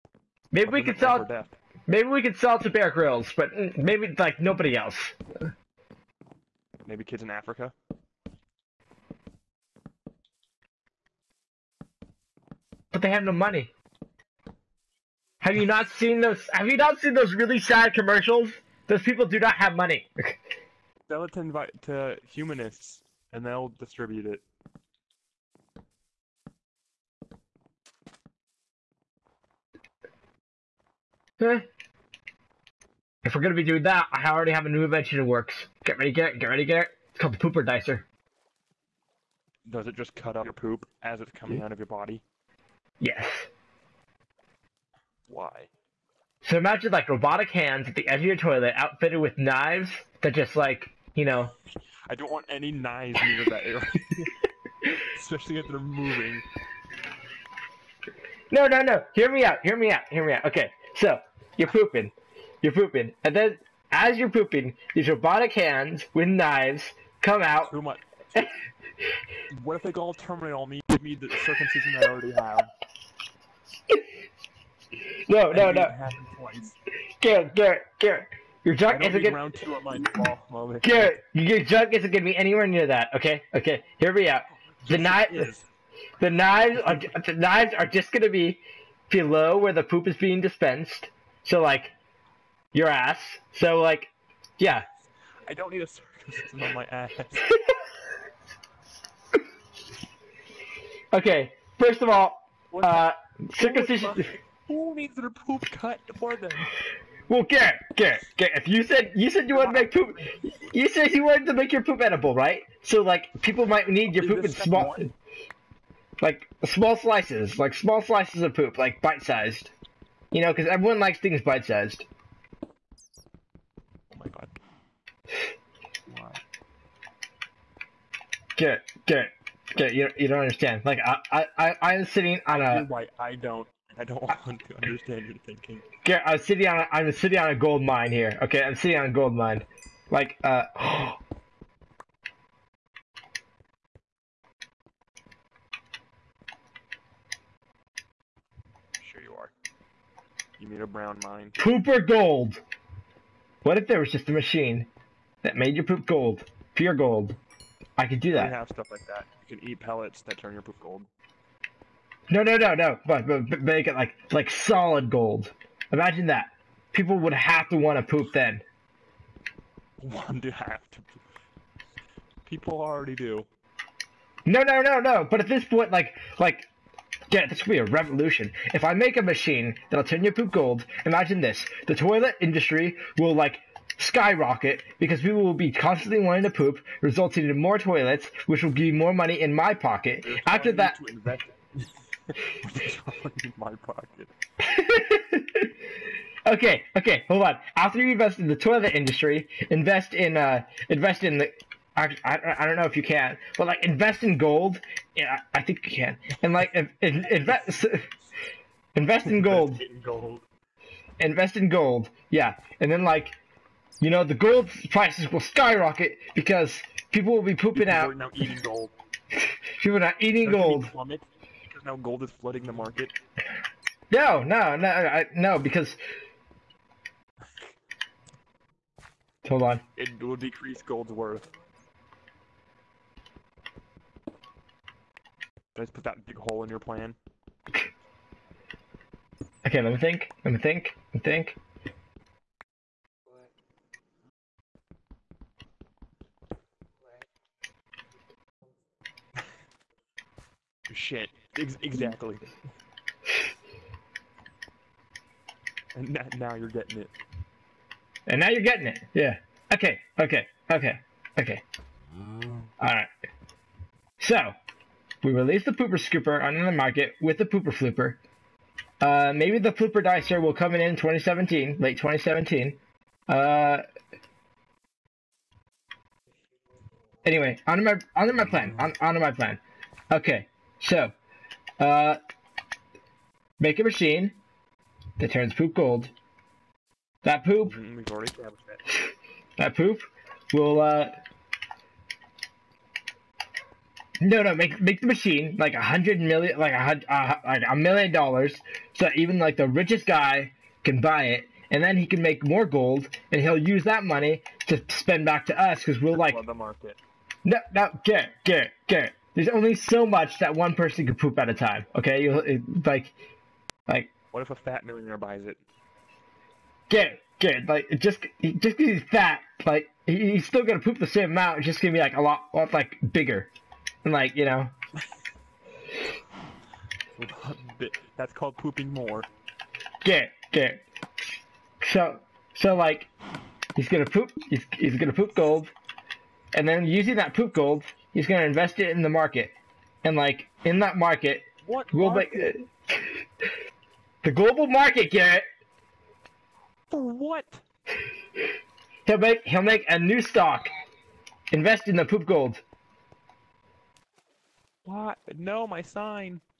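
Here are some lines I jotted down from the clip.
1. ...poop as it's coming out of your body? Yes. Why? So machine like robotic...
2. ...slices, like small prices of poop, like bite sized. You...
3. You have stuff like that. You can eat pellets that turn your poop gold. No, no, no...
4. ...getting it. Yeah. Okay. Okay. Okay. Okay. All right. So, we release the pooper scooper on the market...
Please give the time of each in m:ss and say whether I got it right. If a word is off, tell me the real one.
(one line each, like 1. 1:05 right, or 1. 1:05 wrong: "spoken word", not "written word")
1. 0:40 wrong: "imagine", not "machine"
2. 1:56 wrong: "slices", not "prices"
3. 2:38 right
4. 4:18 right.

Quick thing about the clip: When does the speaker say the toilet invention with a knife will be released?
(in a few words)
late 2017.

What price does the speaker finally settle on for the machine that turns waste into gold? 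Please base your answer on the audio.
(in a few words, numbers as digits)
a million dollars.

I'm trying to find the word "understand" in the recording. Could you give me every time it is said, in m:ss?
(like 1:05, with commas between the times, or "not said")
2:10, 2:14.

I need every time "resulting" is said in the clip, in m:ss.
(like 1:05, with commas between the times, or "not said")
3:07.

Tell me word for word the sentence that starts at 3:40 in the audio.
Plummet because now gold is flooding the market.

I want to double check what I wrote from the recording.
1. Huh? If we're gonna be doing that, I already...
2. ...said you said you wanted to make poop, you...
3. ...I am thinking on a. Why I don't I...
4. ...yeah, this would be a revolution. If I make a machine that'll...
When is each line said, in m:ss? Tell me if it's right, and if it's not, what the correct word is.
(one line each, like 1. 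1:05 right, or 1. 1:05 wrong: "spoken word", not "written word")
1. 0:31 right
2. 1:48 right
3. 2:11 wrong: "sitting", not "thinking"
4. 2:57 right.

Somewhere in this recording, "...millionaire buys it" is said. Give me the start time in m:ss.
5:14.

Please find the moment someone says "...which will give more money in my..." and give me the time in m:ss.
3:08.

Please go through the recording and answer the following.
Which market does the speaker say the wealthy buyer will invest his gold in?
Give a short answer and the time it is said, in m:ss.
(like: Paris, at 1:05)
the global market, at 5:44.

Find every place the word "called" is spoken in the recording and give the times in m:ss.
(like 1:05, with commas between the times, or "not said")
0:37, 5:28.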